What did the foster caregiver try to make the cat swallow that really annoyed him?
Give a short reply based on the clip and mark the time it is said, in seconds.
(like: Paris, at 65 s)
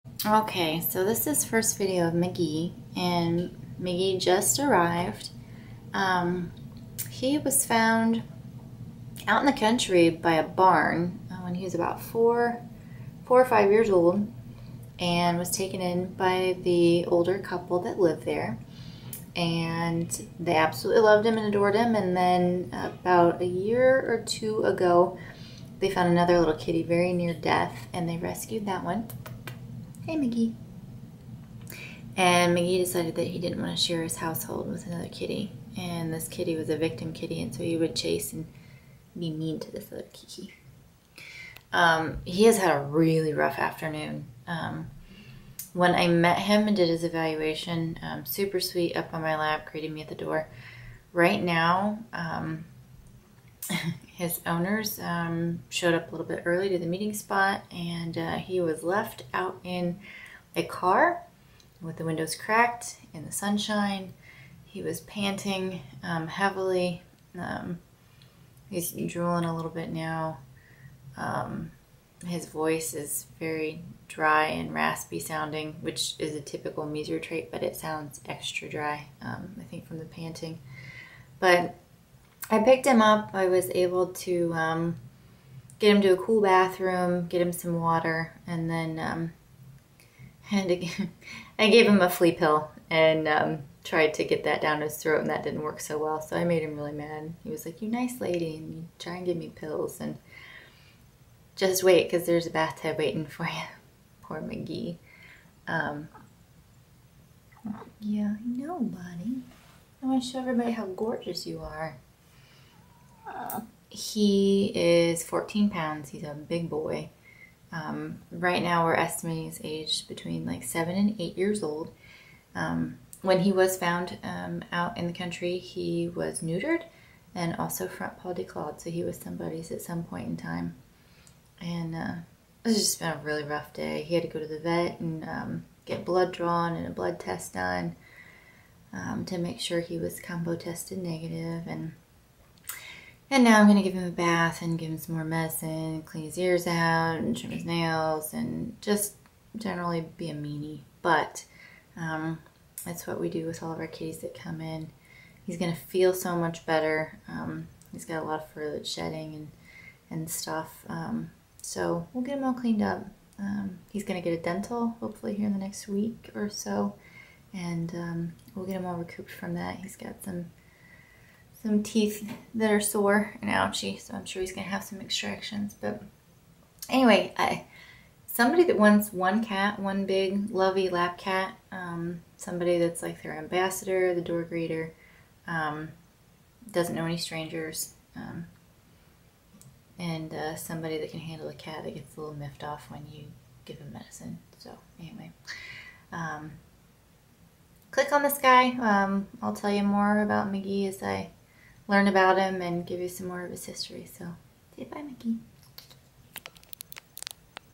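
A flea pill, at 92 s.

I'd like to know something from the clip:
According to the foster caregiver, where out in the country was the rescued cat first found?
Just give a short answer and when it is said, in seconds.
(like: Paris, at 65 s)
By a barn, at 10 s.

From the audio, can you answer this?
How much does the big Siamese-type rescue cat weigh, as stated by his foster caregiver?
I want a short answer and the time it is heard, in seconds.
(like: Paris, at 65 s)
14 pounds, at 115 s.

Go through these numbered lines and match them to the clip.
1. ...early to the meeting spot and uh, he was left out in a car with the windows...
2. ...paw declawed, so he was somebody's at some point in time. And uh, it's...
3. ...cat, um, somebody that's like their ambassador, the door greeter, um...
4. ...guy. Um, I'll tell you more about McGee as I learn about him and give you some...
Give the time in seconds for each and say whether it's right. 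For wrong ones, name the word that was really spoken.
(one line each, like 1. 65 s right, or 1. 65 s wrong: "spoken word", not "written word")
1. 56 s right
2. 128 s right
3. 181 s right
4. 198 s right.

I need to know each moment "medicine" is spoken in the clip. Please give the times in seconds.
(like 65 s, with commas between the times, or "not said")
145 s, 193 s.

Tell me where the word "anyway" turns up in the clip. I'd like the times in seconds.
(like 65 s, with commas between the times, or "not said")
176 s, 194 s.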